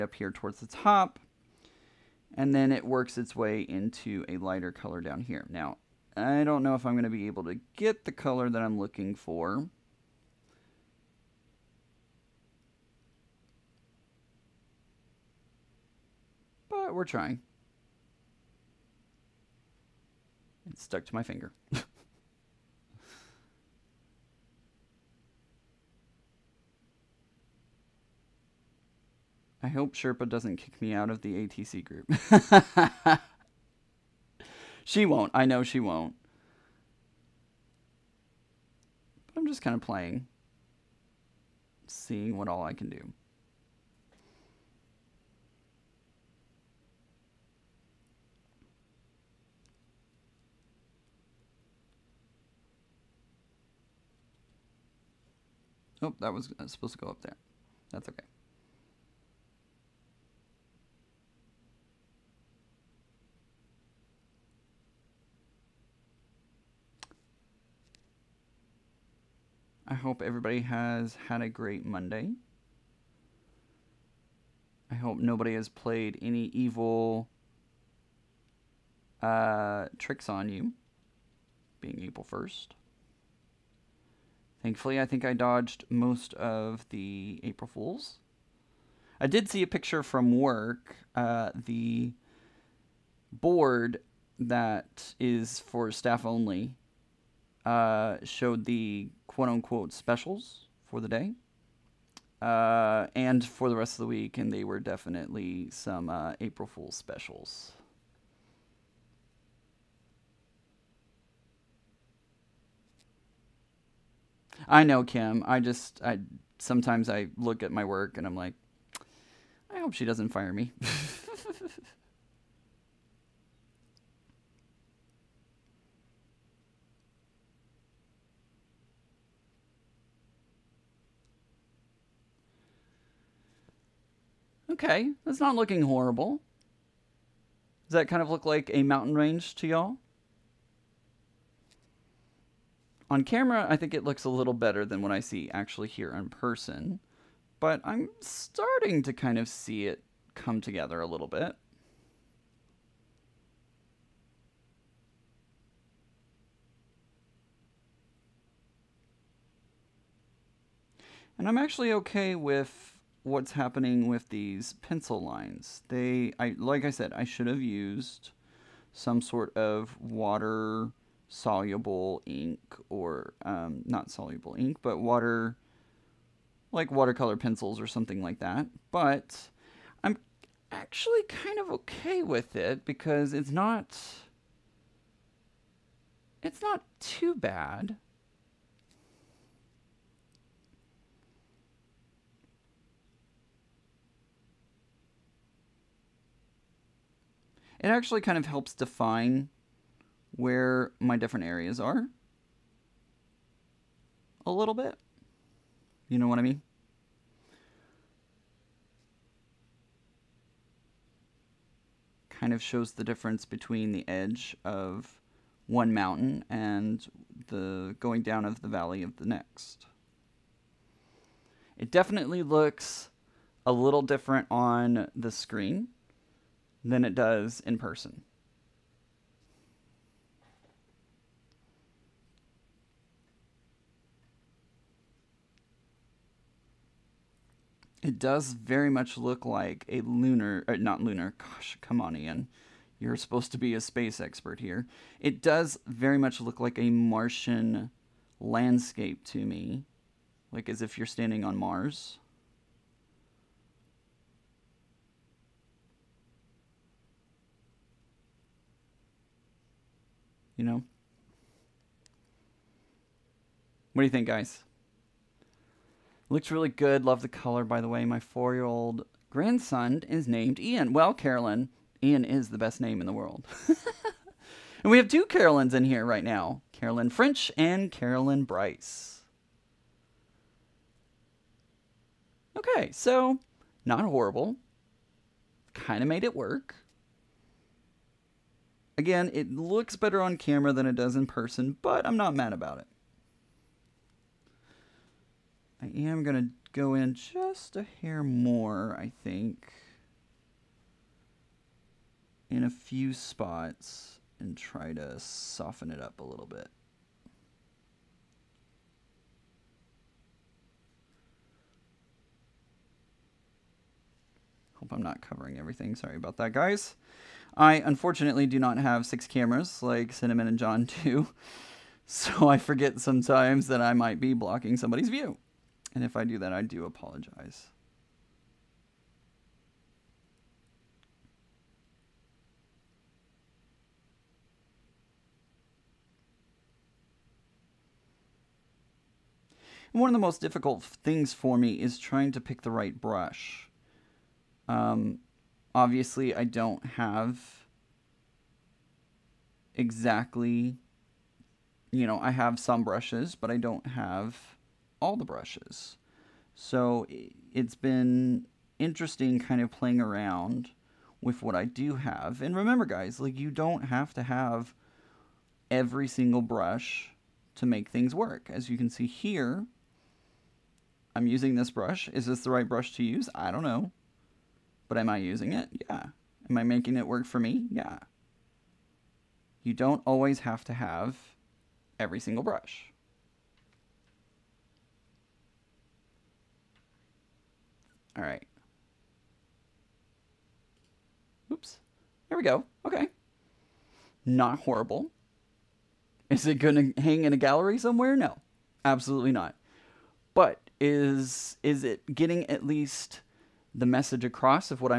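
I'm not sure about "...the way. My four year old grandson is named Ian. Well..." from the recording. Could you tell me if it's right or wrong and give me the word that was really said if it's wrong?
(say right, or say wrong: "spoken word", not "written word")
right.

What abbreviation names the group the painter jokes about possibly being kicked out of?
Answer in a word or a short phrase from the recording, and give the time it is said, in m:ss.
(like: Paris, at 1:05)
ATC, at 0:31.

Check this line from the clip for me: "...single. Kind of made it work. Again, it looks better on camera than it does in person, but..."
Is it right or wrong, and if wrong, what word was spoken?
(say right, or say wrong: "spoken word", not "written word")
wrong: "horrible", not "single".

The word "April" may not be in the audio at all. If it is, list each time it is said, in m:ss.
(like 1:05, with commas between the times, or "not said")
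1:22, 1:27, 1:46.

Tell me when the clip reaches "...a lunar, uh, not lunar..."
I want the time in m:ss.
3:59.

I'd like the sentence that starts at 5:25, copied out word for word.
And if I do that, I do apologize.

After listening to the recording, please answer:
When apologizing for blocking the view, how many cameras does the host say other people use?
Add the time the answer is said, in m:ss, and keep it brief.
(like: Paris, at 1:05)
6, at 5:19.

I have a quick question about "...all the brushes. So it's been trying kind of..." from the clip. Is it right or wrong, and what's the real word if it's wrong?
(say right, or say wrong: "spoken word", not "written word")
wrong: "interesting", not "trying".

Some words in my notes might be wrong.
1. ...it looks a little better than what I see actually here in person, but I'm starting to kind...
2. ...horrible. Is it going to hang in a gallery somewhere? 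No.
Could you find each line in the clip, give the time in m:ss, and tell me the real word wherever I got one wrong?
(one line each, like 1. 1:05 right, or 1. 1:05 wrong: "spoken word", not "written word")
1. 2:23 right
2. 6:34 right.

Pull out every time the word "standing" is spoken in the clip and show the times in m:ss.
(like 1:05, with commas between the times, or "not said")
4:11.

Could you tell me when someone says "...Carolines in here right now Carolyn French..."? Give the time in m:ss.
4:35.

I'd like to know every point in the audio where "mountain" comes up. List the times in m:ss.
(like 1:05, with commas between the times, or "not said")
2:18, 3:35.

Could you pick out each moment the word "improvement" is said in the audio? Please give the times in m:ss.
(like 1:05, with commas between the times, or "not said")
not said.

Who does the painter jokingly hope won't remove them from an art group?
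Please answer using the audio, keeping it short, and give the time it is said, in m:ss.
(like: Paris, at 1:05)
Sherpa, at 0:29.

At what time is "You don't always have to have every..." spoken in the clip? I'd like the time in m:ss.
6:19.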